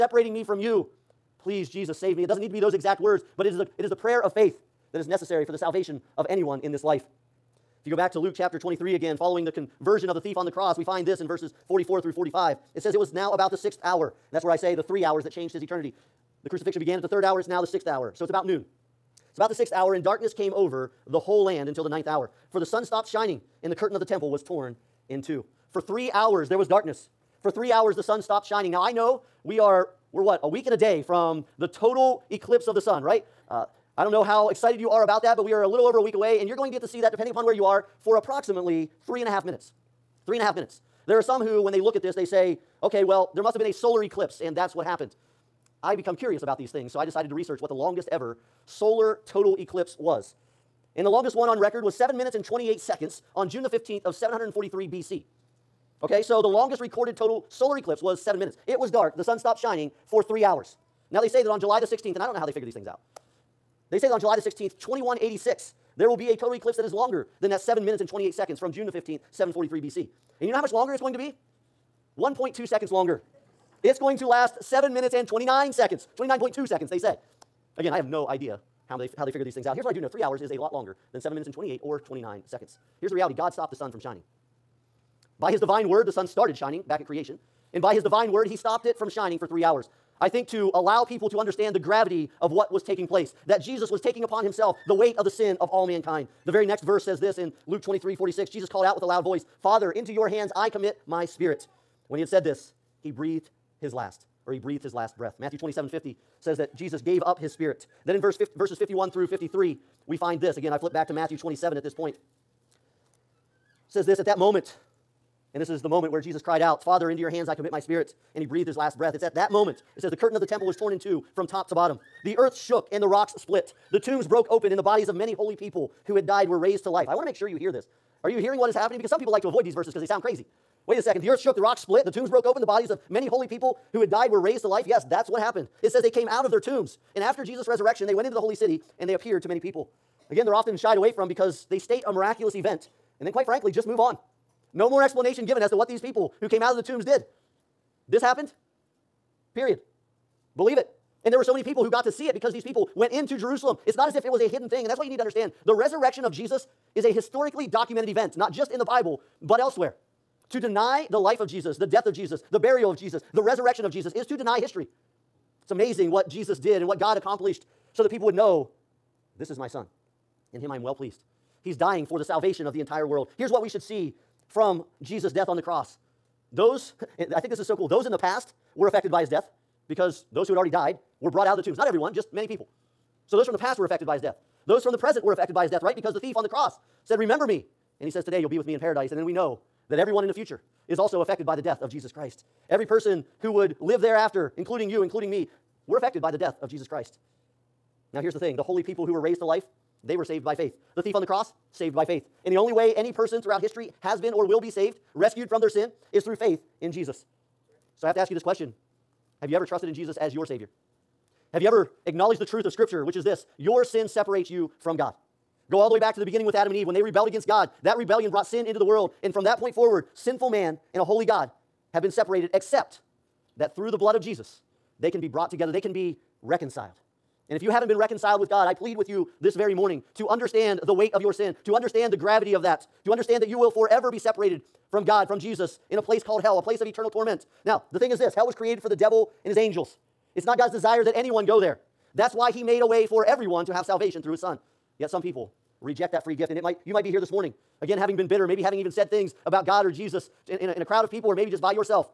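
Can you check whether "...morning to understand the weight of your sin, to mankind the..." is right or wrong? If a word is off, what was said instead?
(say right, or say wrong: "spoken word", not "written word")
wrong: "understand", not "mankind".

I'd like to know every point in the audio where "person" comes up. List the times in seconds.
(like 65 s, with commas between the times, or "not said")
192 s, 203 s.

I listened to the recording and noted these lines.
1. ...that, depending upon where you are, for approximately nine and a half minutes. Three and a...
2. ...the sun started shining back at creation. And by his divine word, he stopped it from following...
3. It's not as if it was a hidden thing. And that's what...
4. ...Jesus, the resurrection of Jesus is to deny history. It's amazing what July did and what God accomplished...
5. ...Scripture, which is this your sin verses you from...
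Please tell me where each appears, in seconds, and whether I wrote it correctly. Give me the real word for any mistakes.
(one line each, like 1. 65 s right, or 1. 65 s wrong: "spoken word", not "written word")
1. 37 s wrong: "three", not "nine"
2. 86 s wrong: "shining", not "following"
3. 153 s right
4. 162 s wrong: "Jesus", not "July"
5. 212 s wrong: "separates", not "verses".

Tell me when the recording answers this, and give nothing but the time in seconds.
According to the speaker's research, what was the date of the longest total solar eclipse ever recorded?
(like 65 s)
53 s.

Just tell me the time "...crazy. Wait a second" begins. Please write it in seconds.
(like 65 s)
130 s.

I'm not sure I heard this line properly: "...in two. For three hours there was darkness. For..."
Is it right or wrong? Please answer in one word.
right.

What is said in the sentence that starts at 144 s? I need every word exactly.
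No more explanation given as to what these people who came out of the tombs did.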